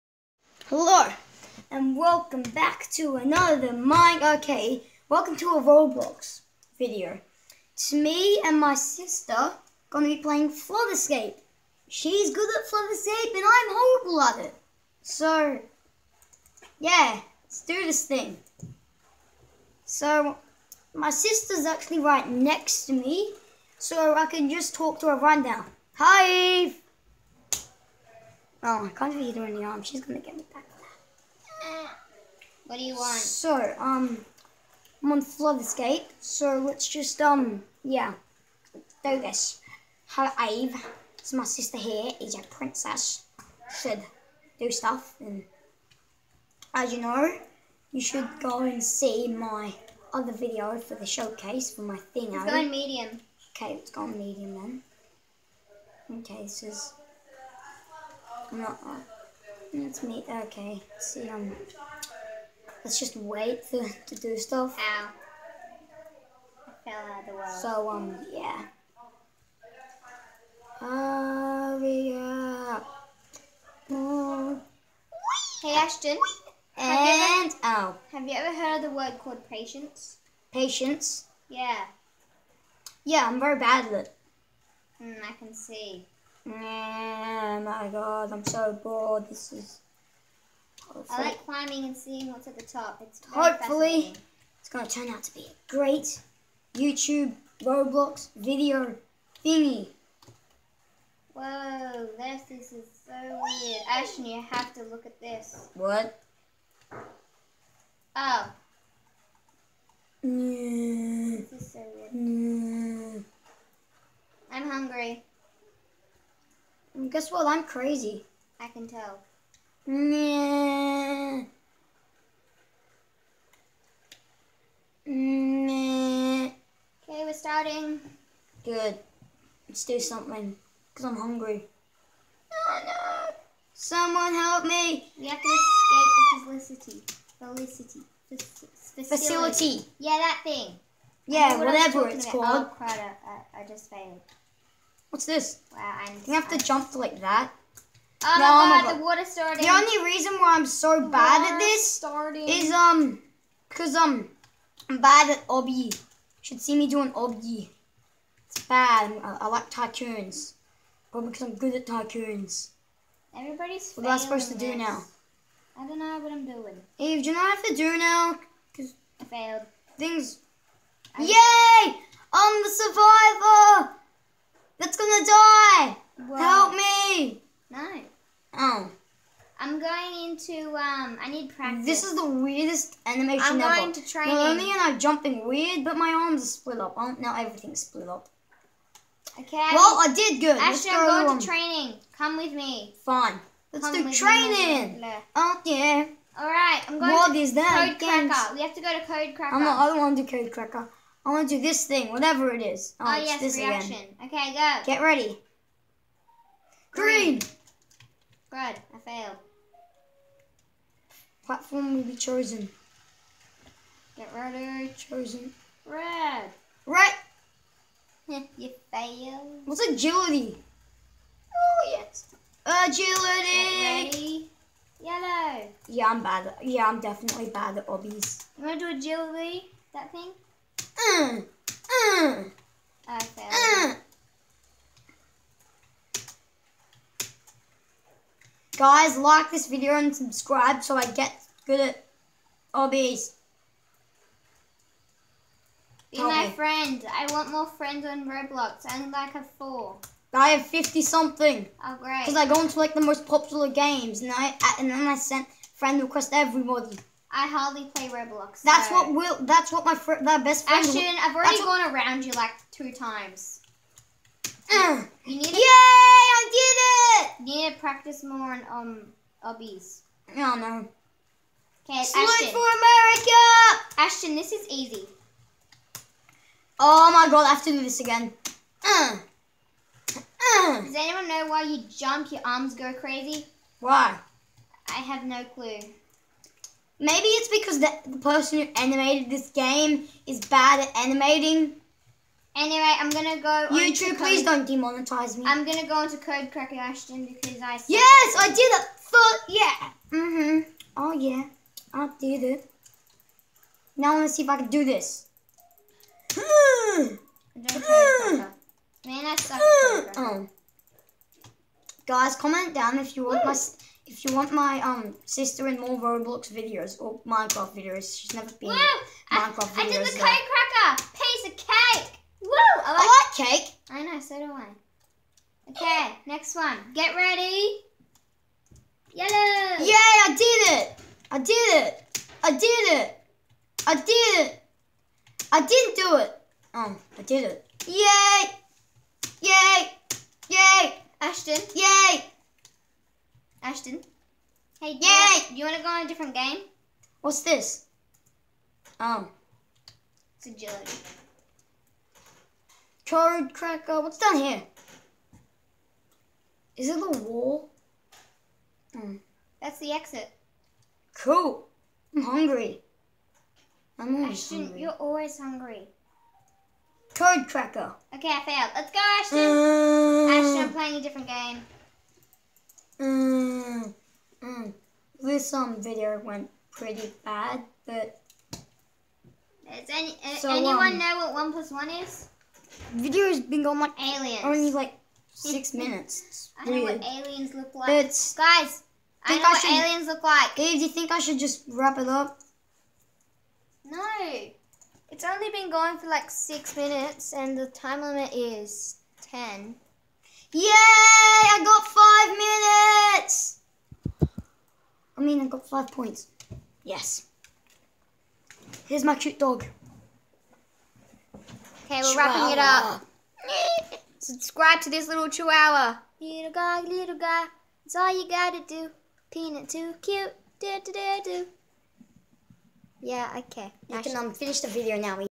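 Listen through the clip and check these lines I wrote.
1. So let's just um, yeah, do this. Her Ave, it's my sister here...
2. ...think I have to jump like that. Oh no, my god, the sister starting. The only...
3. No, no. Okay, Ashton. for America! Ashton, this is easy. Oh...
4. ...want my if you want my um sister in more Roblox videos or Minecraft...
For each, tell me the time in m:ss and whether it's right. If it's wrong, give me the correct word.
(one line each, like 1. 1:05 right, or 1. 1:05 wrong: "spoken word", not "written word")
1. 0:36 right
2. 2:26 wrong: "water", not "sister"
3. 4:30 right
4. 5:13 right.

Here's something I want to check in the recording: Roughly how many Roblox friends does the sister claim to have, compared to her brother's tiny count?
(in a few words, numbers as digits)
50 something.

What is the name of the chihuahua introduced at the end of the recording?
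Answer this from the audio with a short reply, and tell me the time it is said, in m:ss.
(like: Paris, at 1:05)
Peanut, at 6:59.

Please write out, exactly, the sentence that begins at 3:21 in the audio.
I want to do this thing, whatever it is.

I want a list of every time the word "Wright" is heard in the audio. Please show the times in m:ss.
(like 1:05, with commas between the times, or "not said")
not said.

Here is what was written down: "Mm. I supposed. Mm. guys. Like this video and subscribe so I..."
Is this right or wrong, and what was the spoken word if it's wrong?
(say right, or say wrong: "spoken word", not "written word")
wrong: "failed", not "supposed".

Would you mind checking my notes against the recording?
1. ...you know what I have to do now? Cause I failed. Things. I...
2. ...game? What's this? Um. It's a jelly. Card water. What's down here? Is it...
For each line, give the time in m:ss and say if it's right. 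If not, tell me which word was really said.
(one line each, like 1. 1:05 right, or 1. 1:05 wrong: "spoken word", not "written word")
1. 2:47 right
2. 5:46 wrong: "cracker", not "water".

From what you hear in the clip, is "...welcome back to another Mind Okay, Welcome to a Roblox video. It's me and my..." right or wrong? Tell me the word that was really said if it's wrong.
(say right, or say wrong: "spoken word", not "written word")
right.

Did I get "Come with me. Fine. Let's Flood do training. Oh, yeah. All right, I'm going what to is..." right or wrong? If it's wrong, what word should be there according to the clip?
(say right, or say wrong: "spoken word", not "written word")
wrong: "Come", not "Flood".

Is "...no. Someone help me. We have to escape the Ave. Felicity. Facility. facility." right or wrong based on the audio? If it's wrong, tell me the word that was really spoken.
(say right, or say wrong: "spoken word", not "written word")
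wrong: "Felicity", not "Ave".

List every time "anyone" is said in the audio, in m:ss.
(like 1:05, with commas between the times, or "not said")
4:40, 6:20.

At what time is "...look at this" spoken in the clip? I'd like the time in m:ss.
1:44.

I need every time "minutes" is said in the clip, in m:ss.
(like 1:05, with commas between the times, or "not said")
6:25, 6:36, 6:43.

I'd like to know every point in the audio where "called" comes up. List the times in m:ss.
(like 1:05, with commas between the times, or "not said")
1:19, 2:22.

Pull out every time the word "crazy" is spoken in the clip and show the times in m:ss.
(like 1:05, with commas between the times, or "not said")
1:57, 4:42.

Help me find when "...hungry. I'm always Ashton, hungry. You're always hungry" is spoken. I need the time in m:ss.
6:02.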